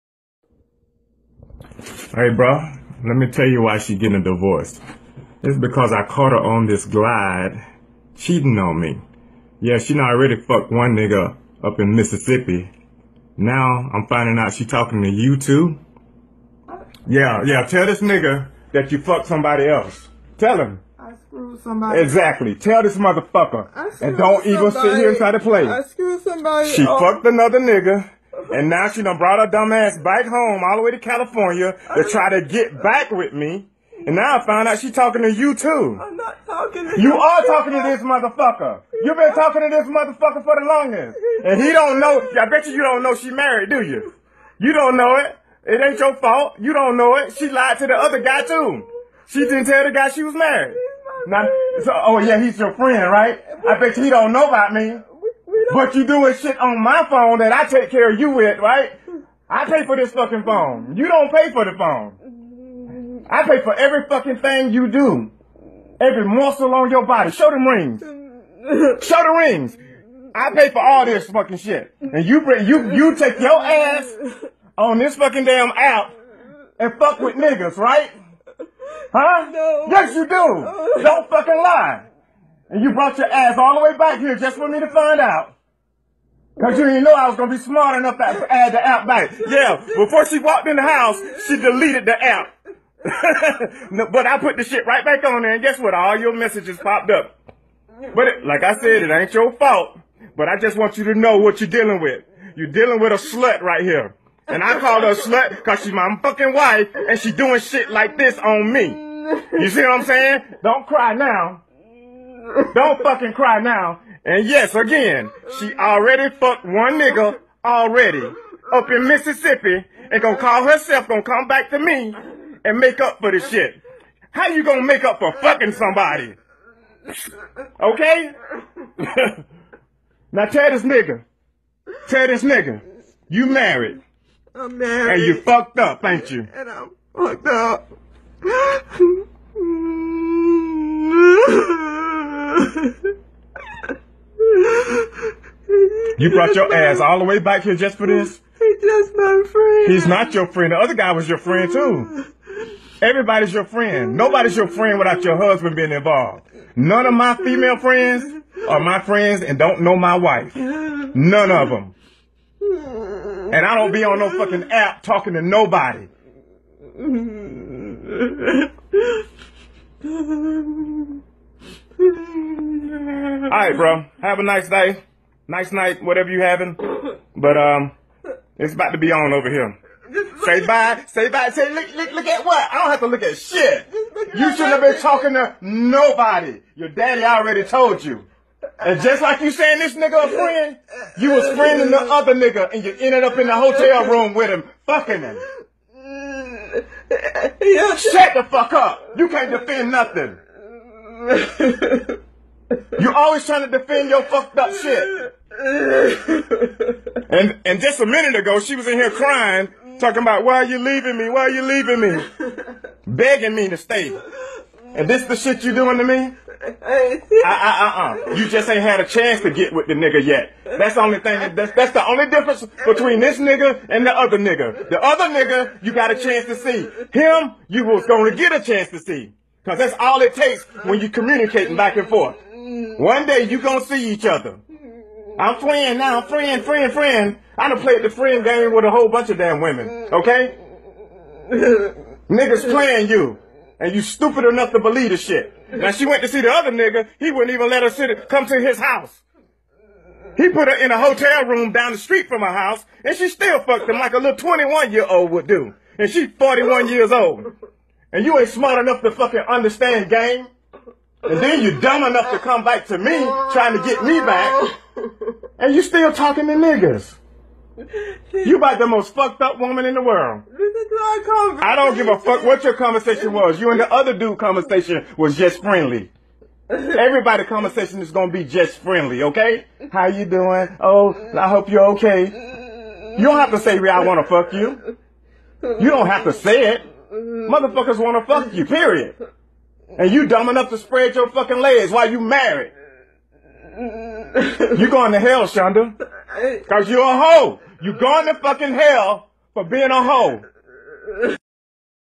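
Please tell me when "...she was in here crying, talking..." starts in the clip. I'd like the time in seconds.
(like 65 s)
208 s.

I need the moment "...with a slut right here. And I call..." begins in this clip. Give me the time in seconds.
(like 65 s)
102 s.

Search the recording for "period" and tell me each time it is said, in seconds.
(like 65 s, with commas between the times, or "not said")
288 s.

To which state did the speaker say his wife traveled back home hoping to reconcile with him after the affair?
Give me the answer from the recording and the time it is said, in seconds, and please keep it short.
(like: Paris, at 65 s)
California, at 30 s.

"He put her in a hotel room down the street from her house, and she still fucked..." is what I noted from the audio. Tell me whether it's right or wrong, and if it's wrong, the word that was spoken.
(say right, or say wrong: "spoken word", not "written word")
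right.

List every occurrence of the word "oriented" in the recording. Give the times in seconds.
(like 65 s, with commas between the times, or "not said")
not said.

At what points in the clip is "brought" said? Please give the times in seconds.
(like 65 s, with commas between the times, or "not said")
29 s, 82 s, 146 s.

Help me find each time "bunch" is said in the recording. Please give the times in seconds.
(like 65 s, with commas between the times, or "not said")
239 s.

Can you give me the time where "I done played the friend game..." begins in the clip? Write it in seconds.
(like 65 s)
237 s.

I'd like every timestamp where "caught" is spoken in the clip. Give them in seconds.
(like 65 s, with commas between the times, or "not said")
6 s.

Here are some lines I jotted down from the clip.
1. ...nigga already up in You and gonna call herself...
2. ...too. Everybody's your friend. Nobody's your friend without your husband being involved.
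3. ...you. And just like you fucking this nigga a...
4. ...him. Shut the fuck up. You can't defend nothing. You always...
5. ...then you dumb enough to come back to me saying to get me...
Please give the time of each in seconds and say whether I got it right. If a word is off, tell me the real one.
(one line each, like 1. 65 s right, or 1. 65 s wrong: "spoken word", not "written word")
1. 116 s wrong: "Mississippi", not "You"
2. 151 s right
3. 188 s wrong: "saying", not "fucking"
4. 195 s right
5. 261 s wrong: "trying", not "saying".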